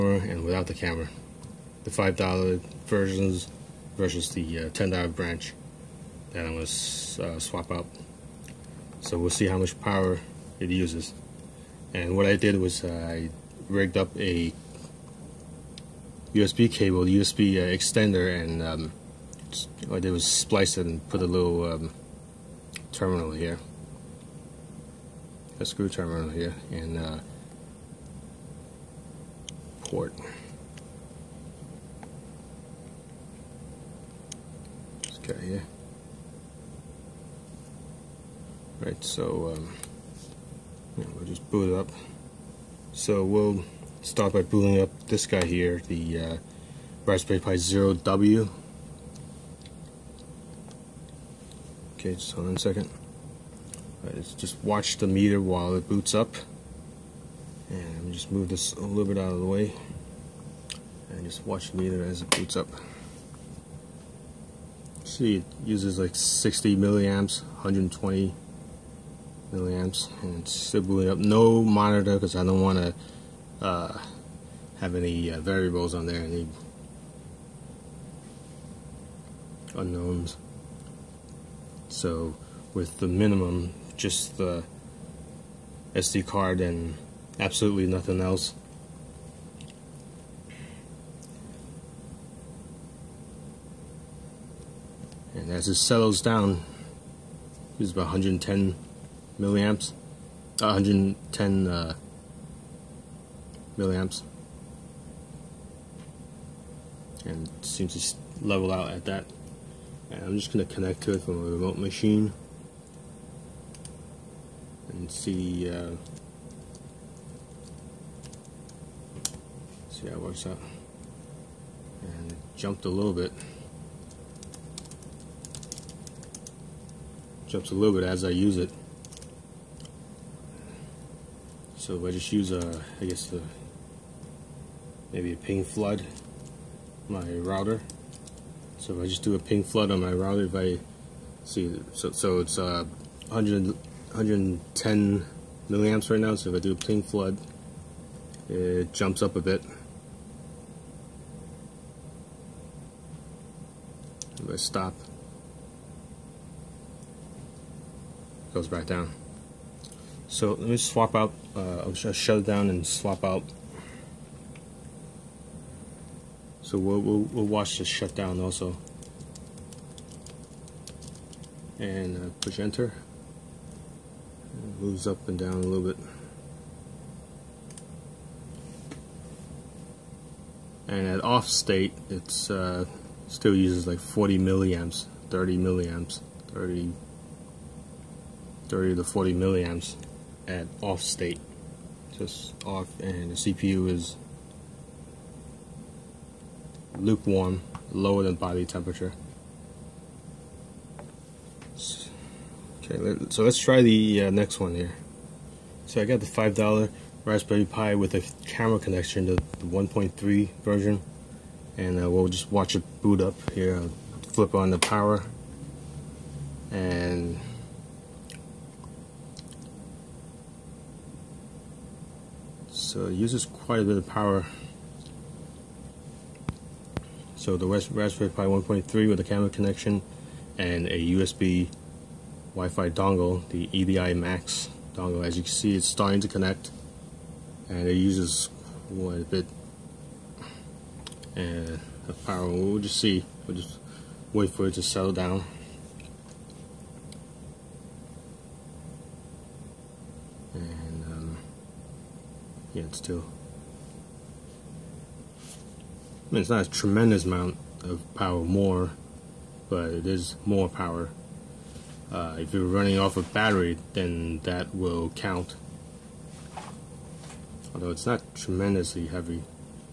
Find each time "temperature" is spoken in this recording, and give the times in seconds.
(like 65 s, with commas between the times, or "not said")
198 s.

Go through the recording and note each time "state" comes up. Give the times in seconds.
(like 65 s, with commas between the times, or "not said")
181 s, 191 s.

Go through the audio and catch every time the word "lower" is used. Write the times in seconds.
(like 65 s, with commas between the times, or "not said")
197 s.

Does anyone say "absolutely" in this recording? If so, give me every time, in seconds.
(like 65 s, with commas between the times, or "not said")
87 s.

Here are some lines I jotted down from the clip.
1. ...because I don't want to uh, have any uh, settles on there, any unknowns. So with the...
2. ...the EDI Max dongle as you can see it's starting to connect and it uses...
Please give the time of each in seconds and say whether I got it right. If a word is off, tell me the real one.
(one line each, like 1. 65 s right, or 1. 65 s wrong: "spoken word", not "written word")
1. 72 s wrong: "variables", not "settles"
2. 233 s right.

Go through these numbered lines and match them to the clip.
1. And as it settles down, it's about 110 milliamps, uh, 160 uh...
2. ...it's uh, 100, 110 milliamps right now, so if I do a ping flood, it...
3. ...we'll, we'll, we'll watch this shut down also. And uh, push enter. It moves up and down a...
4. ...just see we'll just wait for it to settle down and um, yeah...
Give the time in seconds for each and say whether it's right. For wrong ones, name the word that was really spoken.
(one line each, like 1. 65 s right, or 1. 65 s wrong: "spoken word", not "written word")
1. 95 s wrong: "110", not "160"
2. 142 s right
3. 166 s right
4. 242 s right.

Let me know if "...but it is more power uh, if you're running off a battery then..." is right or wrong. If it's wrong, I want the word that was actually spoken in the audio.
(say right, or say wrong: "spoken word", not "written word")
right.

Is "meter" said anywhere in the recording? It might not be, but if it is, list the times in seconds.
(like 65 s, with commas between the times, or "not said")
55 s, 61 s.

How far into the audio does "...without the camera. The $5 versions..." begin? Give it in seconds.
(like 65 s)
0 s.